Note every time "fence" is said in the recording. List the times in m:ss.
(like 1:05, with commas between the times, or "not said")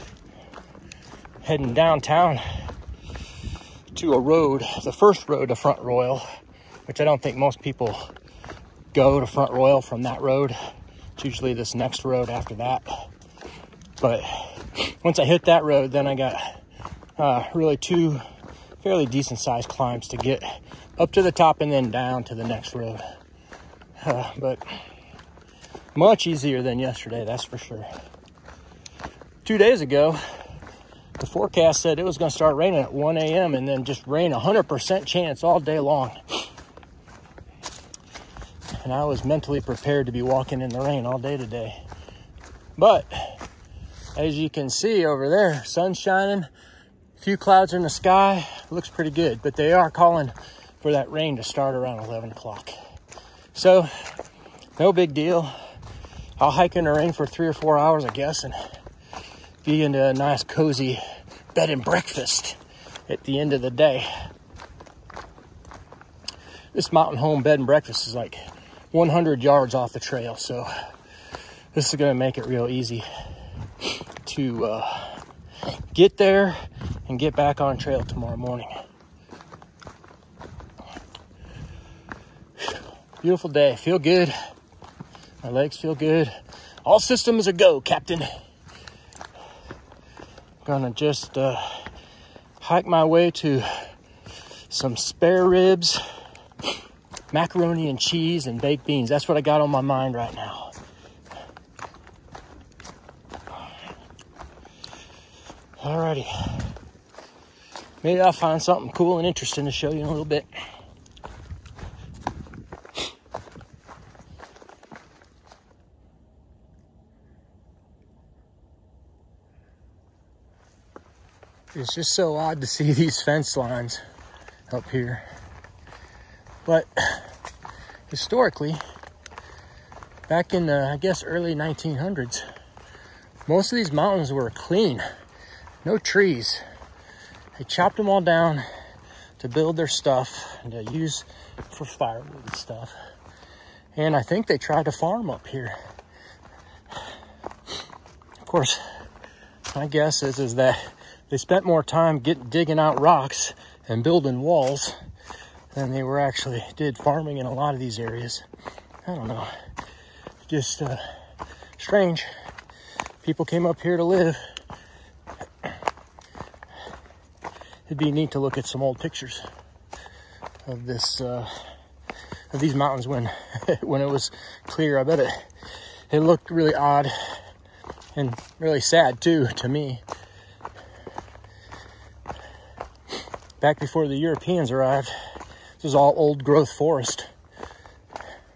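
2:03.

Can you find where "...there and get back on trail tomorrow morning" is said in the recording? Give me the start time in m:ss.
1:16.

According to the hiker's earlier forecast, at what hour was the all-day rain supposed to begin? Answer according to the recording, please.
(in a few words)
1 a.m.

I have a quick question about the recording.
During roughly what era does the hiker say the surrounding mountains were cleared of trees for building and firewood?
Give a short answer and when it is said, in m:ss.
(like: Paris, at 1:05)
early 1900s, at 2:11.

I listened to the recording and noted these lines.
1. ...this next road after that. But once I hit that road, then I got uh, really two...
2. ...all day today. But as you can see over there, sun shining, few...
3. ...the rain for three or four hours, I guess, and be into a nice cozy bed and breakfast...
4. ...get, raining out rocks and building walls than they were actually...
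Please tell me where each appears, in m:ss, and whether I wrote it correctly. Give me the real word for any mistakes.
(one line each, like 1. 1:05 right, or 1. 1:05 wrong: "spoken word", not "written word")
1. 0:11 right
2. 0:41 right
3. 0:56 right
4. 2:32 wrong: "digging", not "raining".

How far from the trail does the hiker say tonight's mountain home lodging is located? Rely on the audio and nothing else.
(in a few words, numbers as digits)
100 yards.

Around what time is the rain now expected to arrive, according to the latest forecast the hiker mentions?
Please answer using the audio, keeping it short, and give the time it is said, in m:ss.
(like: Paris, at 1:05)
11 o'clock, at 0:51.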